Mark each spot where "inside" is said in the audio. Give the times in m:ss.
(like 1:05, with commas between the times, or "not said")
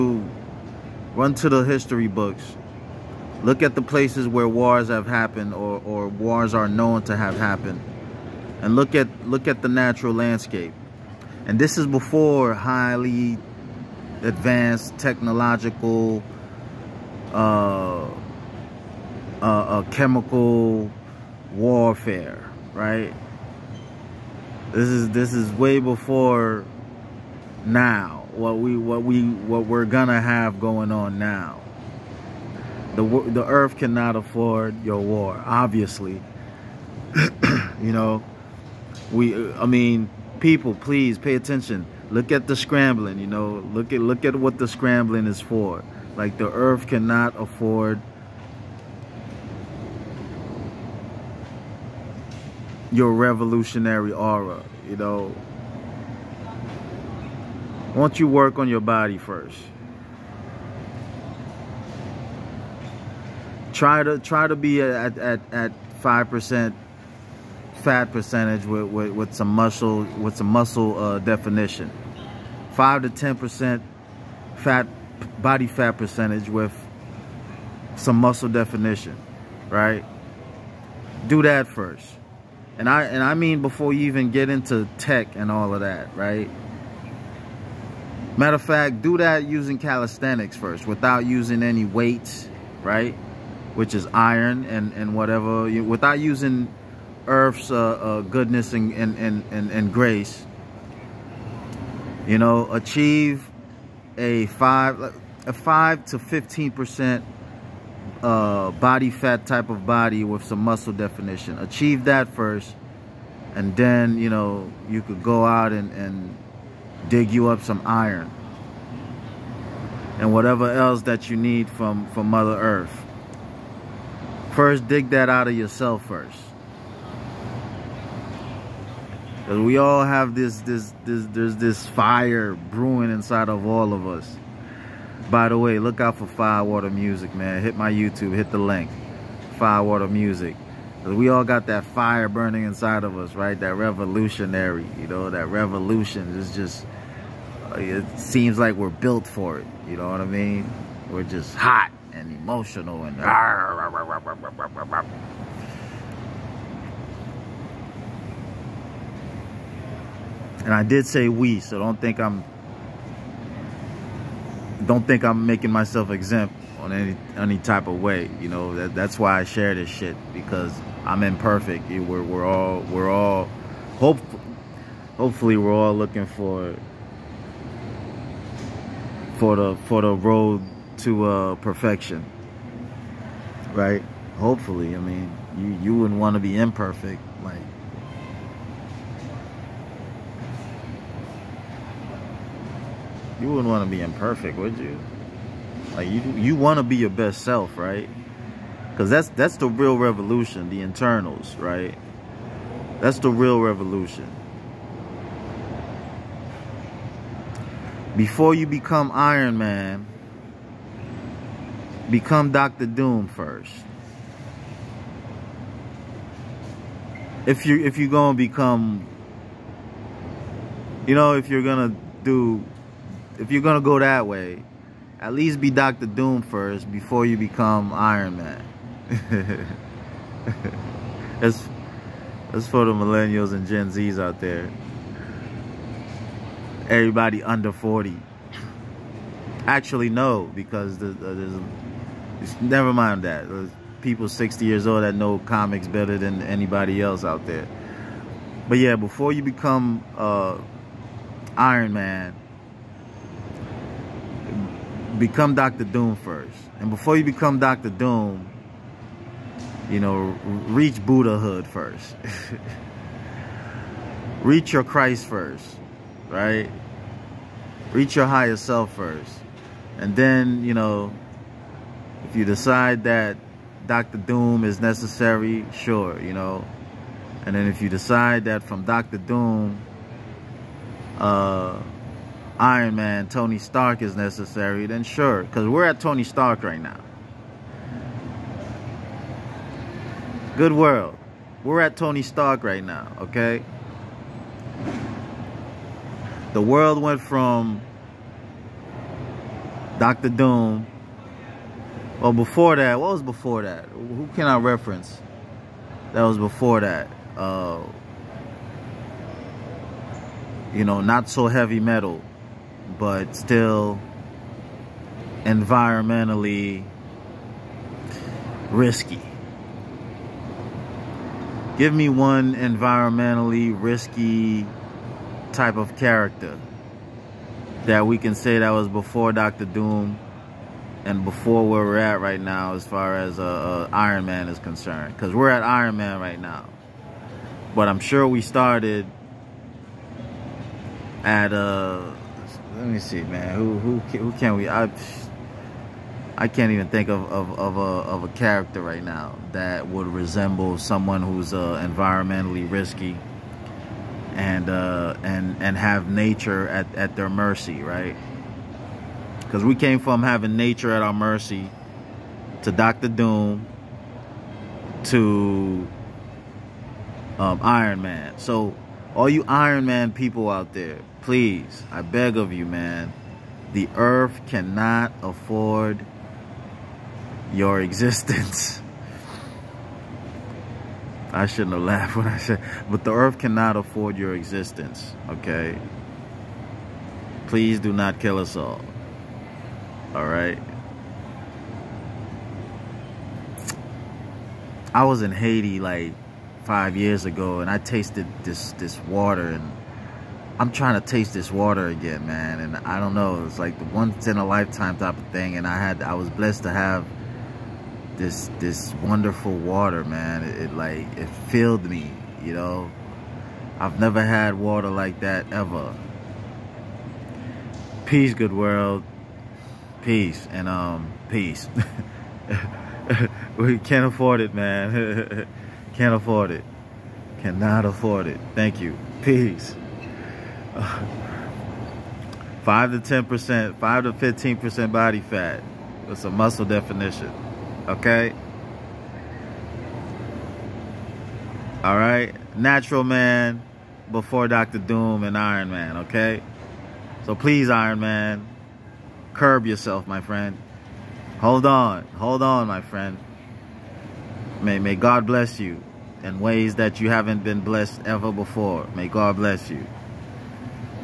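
2:13, 2:22.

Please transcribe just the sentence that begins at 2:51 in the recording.
We're we're all we're all hope hopefully we're all looking for for the for the road to uh, perfection.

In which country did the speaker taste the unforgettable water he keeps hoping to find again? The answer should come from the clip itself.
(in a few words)
Haiti.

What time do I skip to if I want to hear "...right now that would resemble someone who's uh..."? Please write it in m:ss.
5:48.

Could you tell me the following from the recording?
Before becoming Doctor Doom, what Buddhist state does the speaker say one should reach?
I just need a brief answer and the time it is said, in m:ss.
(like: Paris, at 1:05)
Buddhahood, at 4:21.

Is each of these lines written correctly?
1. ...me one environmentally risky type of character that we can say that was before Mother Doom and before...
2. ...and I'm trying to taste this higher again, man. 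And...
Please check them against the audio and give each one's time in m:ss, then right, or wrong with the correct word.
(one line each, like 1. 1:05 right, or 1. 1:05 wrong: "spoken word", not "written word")
1. 5:21 wrong: "Doctor", not "Mother"
2. 6:39 wrong: "water", not "higher".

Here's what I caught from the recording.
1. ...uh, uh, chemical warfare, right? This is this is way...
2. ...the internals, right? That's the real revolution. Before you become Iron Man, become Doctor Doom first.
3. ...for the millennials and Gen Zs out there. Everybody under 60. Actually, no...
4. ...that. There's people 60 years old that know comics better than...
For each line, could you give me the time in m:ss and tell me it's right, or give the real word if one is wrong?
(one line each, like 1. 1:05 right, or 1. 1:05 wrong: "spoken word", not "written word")
1. 0:18 right
2. 3:20 right
3. 3:52 wrong: "40", not "60"
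4. 4:03 right.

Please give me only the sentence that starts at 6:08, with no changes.
So all you Iron Man people out there please, I beg of you, man.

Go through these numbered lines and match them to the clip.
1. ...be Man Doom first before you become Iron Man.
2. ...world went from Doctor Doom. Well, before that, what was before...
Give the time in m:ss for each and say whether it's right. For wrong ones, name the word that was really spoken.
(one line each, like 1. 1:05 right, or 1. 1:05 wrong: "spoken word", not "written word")
1. 3:45 wrong: "Doctor", not "Man"
2. 4:56 right.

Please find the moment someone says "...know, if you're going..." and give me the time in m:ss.
3:41.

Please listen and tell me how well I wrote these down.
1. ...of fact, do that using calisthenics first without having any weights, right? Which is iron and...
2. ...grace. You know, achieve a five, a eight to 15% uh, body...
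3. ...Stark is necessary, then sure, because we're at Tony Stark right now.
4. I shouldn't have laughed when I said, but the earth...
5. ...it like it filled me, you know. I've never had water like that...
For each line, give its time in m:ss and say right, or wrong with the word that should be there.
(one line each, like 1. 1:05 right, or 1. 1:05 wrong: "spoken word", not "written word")
1. 1:28 wrong: "using", not "having"
2. 1:39 wrong: "five", not "eight"
3. 4:43 right
4. 6:21 right
5. 6:50 right.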